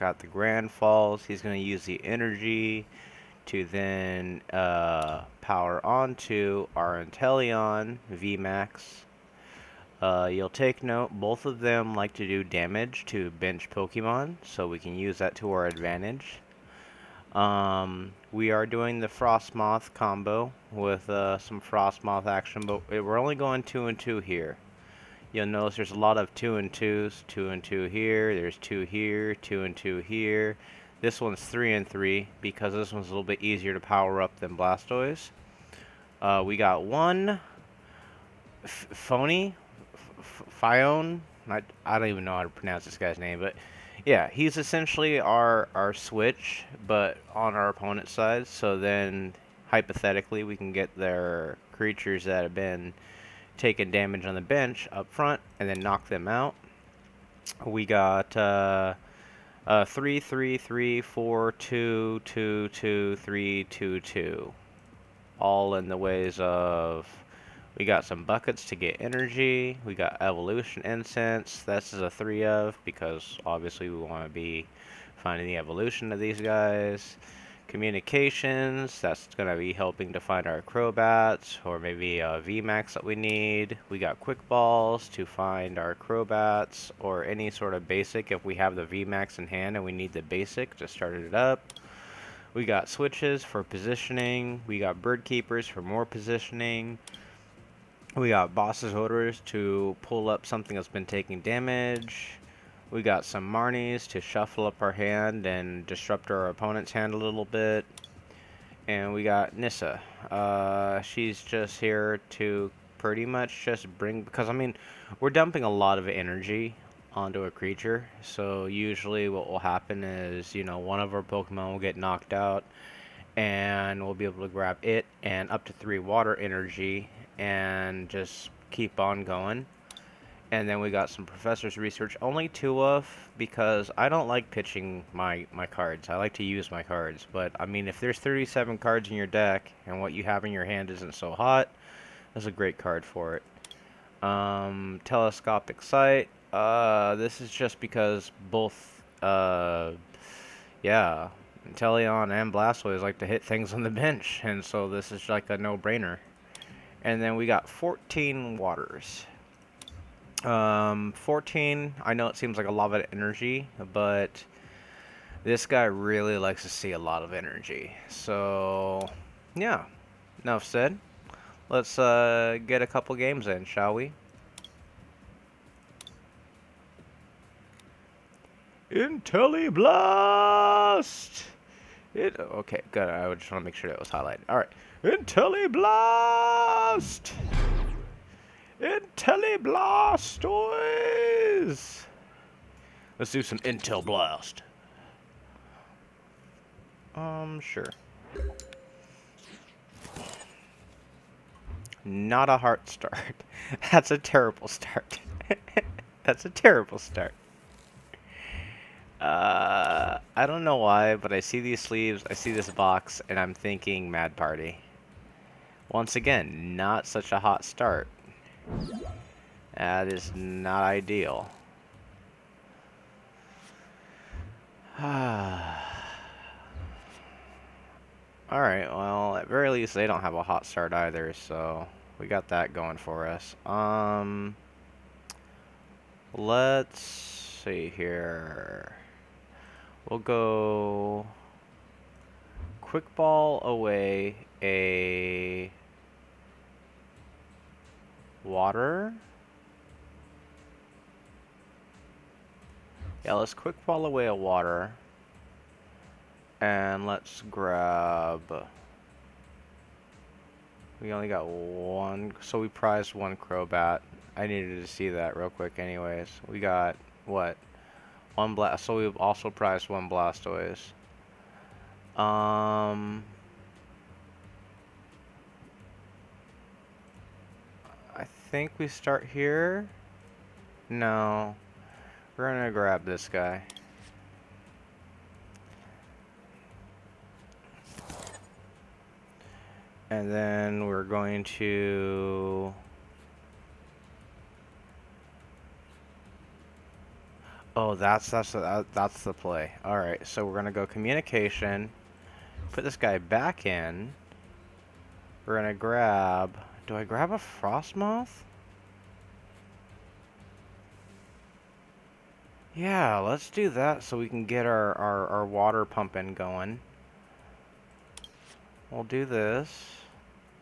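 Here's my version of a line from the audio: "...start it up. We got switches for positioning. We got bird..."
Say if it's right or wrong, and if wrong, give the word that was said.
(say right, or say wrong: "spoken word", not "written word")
right.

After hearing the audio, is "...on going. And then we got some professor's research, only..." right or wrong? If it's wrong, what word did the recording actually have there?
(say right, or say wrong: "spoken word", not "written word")
right.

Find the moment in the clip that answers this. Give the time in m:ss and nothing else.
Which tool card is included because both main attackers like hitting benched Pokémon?
2:25.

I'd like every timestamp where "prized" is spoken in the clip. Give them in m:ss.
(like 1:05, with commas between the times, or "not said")
4:22, 4:29.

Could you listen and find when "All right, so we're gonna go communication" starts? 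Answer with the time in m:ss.
4:59.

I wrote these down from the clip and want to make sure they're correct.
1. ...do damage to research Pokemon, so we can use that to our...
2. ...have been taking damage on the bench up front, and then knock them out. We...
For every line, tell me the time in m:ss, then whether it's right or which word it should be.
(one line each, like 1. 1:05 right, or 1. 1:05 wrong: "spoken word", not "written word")
1. 0:12 wrong: "bench", not "research"
2. 0:52 right.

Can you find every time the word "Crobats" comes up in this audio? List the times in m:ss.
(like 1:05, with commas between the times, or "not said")
1:20, 1:25, 4:23.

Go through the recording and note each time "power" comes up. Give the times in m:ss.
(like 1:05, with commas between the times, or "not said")
0:05, 0:33.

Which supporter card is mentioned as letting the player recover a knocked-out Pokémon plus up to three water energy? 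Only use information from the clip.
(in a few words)
Nessa.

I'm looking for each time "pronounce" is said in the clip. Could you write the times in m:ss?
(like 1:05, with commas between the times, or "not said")
0:42.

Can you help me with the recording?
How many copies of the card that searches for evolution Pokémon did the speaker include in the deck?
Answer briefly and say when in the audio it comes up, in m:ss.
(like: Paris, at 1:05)
3, at 1:12.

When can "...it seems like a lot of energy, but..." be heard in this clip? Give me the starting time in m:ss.
2:42.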